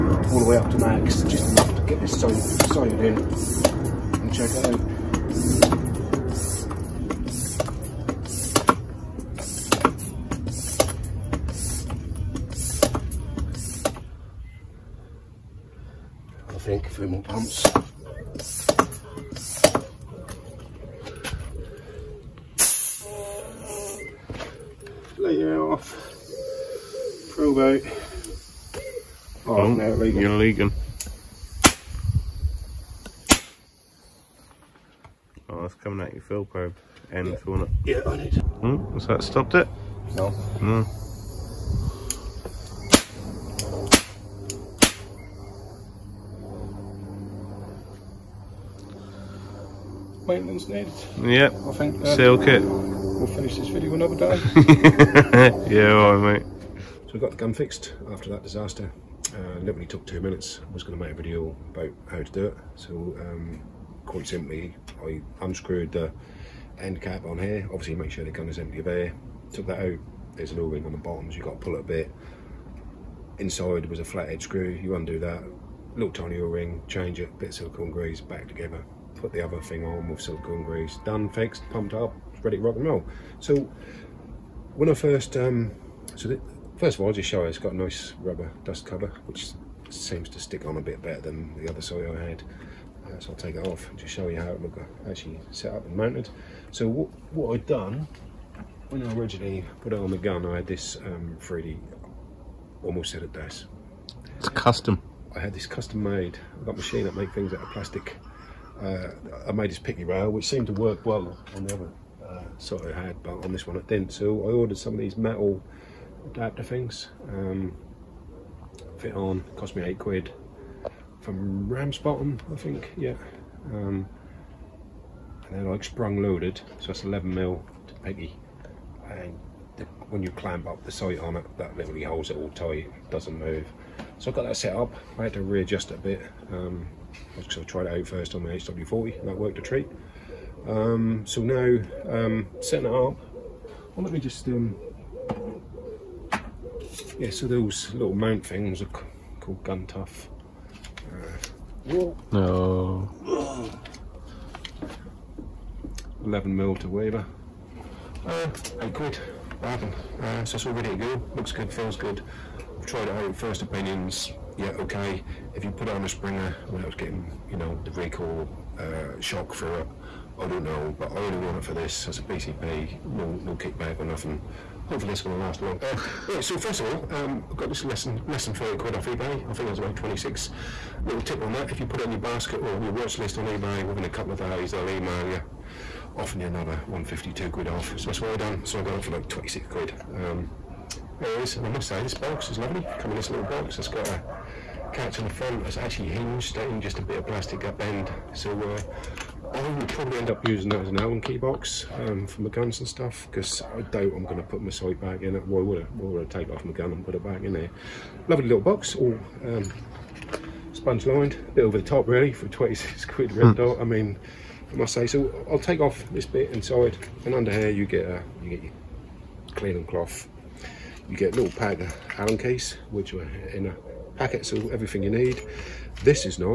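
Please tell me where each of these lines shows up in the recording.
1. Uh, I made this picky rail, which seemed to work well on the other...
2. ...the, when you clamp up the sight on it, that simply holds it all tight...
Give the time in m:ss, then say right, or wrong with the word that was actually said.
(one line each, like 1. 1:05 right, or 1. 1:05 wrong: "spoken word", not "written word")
1. 1:48 right
2. 2:09 wrong: "literally", not "simply".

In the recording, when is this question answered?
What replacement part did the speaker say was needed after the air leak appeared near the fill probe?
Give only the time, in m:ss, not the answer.
0:52.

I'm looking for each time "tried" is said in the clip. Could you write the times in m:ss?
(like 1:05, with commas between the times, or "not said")
2:17, 2:42.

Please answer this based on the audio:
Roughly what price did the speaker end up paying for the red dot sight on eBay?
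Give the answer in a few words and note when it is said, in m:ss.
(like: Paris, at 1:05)
26 quid, at 3:09.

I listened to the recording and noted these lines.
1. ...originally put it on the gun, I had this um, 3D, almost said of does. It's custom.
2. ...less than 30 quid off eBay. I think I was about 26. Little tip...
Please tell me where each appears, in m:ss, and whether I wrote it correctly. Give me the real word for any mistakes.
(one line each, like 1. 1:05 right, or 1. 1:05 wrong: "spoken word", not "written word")
1. 1:39 right
2. 2:58 right.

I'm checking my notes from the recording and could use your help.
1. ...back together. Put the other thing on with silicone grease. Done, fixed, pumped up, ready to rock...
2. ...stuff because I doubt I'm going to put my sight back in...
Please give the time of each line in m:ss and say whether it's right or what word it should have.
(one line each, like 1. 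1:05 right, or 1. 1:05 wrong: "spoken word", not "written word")
1. 1:18 right
2. 3:22 right.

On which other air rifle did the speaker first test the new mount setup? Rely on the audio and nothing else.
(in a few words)
HW40.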